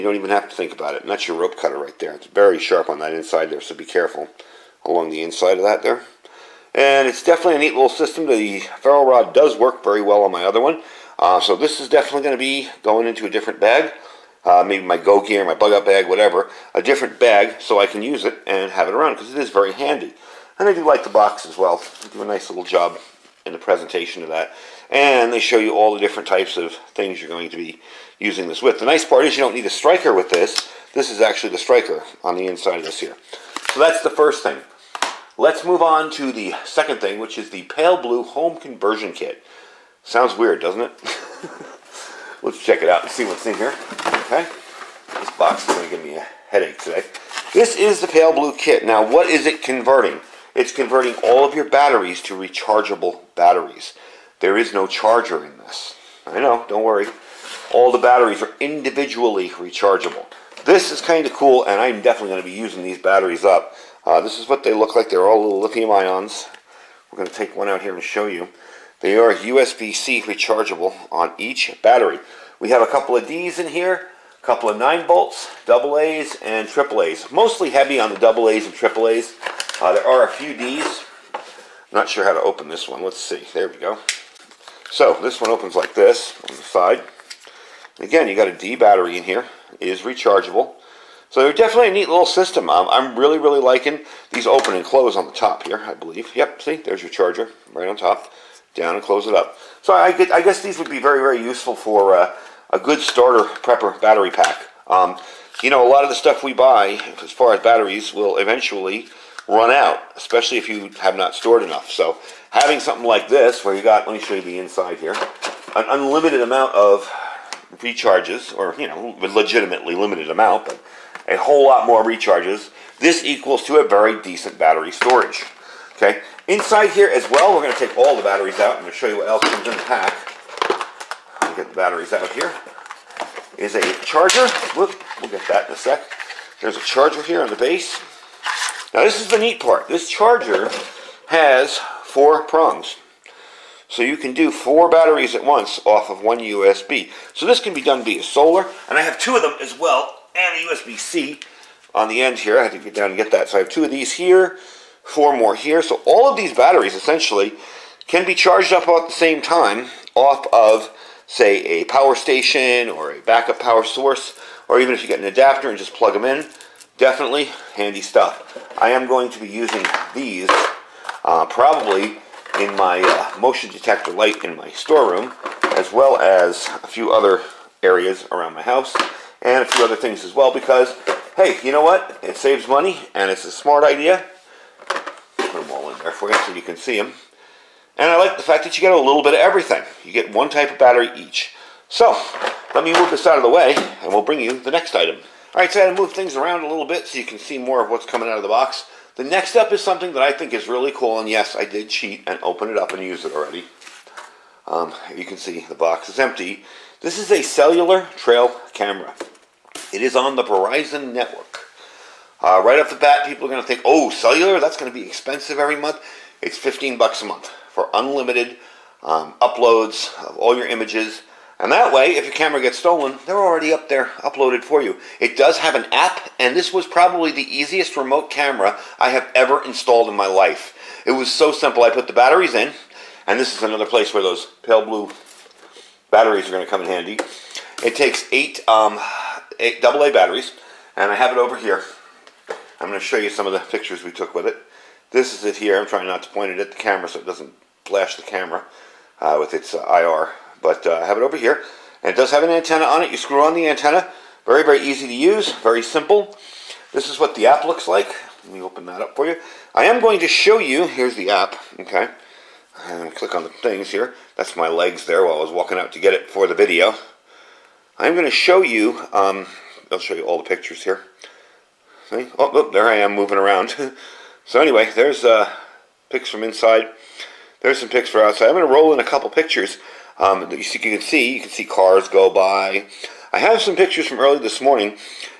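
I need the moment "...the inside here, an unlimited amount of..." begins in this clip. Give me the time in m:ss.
1:54.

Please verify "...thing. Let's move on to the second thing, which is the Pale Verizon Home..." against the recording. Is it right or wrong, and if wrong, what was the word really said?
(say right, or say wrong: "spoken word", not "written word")
wrong: "Blue", not "Verizon".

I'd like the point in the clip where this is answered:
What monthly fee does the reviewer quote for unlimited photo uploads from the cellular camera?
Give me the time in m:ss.
3:36.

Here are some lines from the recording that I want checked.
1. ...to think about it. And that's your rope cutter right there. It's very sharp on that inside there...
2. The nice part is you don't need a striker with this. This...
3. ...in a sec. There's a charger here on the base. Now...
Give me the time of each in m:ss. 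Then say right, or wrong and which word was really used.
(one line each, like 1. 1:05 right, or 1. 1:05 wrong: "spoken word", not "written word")
1. 0:00 right
2. 0:28 right
3. 2:15 right.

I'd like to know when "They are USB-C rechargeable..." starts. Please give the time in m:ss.
1:08.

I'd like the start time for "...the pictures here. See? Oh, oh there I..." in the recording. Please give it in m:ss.
4:30.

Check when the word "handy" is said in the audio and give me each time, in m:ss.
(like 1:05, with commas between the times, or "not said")
0:19, 2:47, 3:56.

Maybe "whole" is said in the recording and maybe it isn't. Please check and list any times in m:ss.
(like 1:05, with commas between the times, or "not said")
2:01.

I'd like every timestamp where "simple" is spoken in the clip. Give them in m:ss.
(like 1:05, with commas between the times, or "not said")
3:51, 4:15.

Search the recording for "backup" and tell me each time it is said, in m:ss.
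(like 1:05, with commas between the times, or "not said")
2:43.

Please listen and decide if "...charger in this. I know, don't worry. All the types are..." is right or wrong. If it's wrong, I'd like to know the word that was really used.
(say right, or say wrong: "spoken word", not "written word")
wrong: "batteries", not "types".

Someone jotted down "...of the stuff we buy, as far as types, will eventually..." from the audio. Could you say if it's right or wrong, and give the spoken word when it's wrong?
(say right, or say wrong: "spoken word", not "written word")
wrong: "batteries", not "types".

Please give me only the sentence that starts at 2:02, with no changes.
This equals to a very decent battery storage.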